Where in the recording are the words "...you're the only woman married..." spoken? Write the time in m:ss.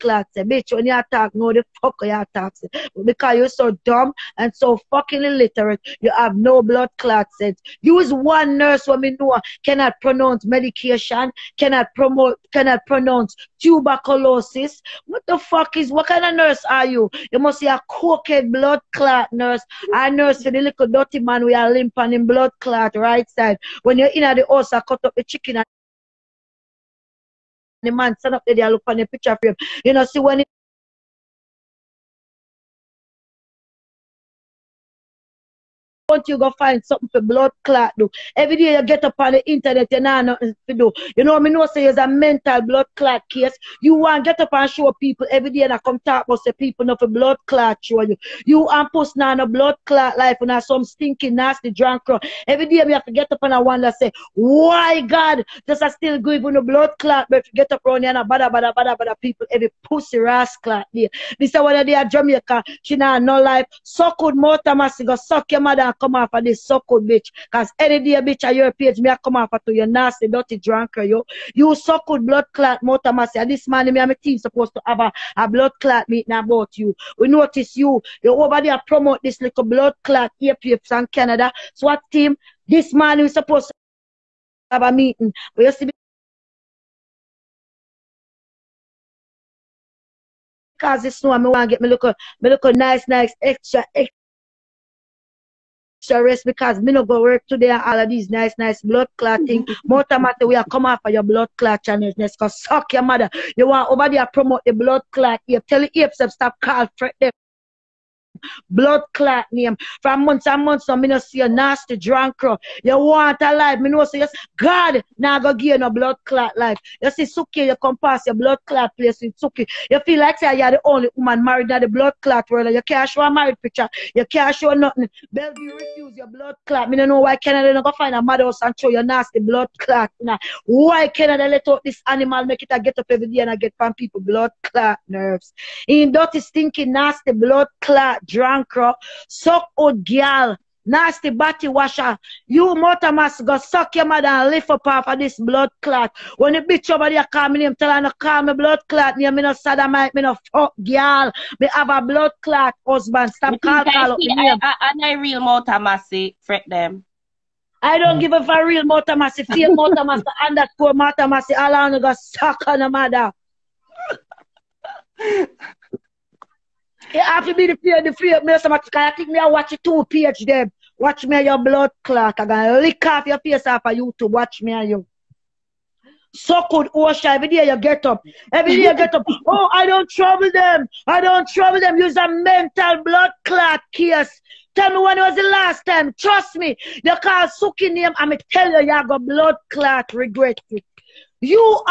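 2:00.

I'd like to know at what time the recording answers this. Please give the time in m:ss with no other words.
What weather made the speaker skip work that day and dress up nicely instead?
1:31.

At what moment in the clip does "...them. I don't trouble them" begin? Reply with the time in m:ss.
3:00.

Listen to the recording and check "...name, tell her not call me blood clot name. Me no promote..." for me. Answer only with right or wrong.
wrong.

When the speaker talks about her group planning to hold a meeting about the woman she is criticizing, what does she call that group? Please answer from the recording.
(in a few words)
SWAT team.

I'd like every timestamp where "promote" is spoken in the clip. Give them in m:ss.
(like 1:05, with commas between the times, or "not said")
0:11, 1:18, 1:44.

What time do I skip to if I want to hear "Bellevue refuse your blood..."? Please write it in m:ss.
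2:05.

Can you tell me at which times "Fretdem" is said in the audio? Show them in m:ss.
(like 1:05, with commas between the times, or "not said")
1:47, 2:36.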